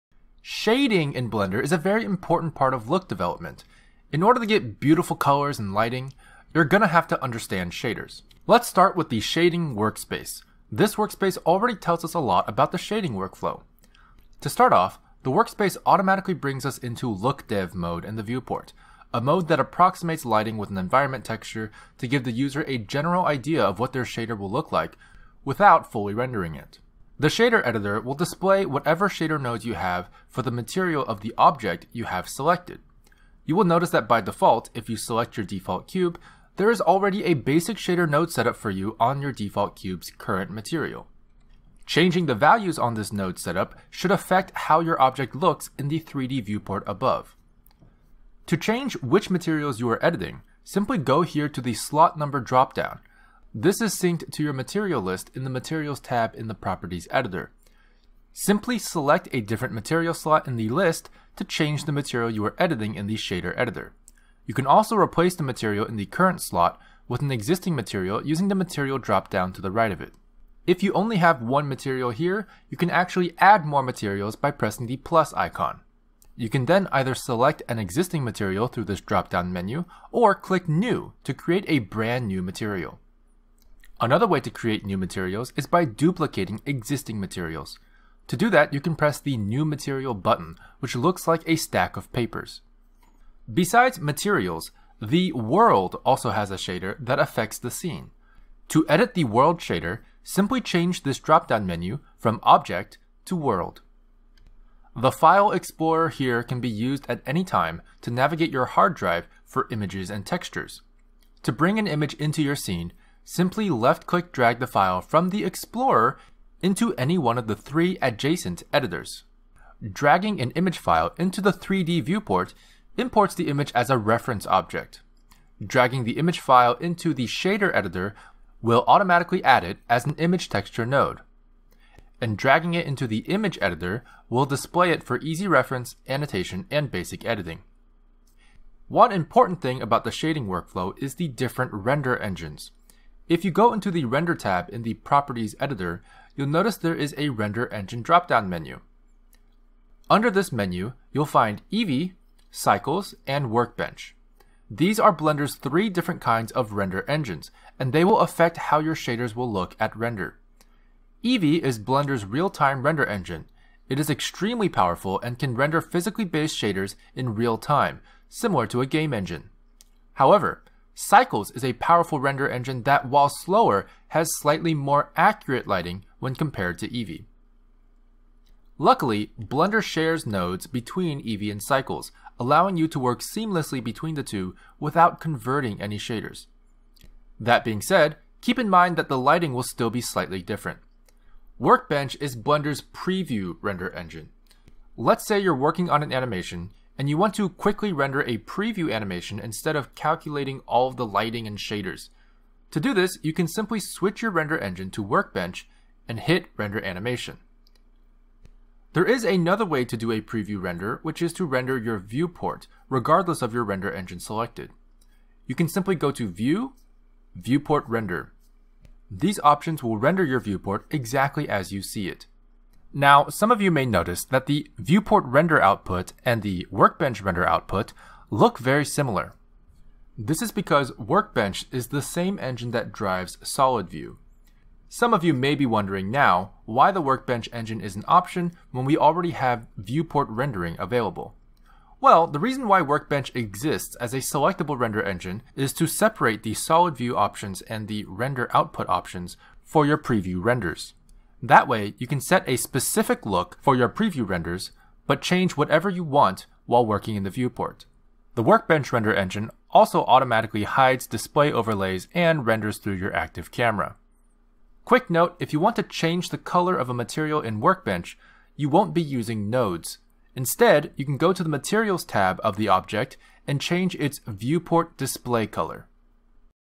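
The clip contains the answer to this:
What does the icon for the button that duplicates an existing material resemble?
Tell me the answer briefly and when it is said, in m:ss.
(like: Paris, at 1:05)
A stack of papers, at 1:31.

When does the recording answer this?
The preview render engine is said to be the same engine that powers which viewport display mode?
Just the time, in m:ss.
3:53.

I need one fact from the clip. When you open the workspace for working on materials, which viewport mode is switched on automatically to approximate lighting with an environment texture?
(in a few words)
Look dev mode.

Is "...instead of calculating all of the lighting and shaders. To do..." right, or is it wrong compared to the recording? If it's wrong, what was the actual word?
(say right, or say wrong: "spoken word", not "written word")
right.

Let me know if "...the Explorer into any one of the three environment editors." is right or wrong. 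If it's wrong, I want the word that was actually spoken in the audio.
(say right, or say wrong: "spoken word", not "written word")
wrong: "adjacent", not "environment".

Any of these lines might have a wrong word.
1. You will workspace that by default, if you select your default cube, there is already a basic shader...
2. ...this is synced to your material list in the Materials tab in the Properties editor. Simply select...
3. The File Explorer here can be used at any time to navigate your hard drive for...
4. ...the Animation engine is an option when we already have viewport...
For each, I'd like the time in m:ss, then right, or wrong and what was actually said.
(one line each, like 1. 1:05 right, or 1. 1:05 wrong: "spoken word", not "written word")
1. 0:33 wrong: "notice", not "workspace"
2. 0:53 right
3. 1:44 right
4. 3:56 wrong: "Workbench", not "Animation".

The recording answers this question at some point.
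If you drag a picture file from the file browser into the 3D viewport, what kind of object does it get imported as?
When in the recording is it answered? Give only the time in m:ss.
2:03.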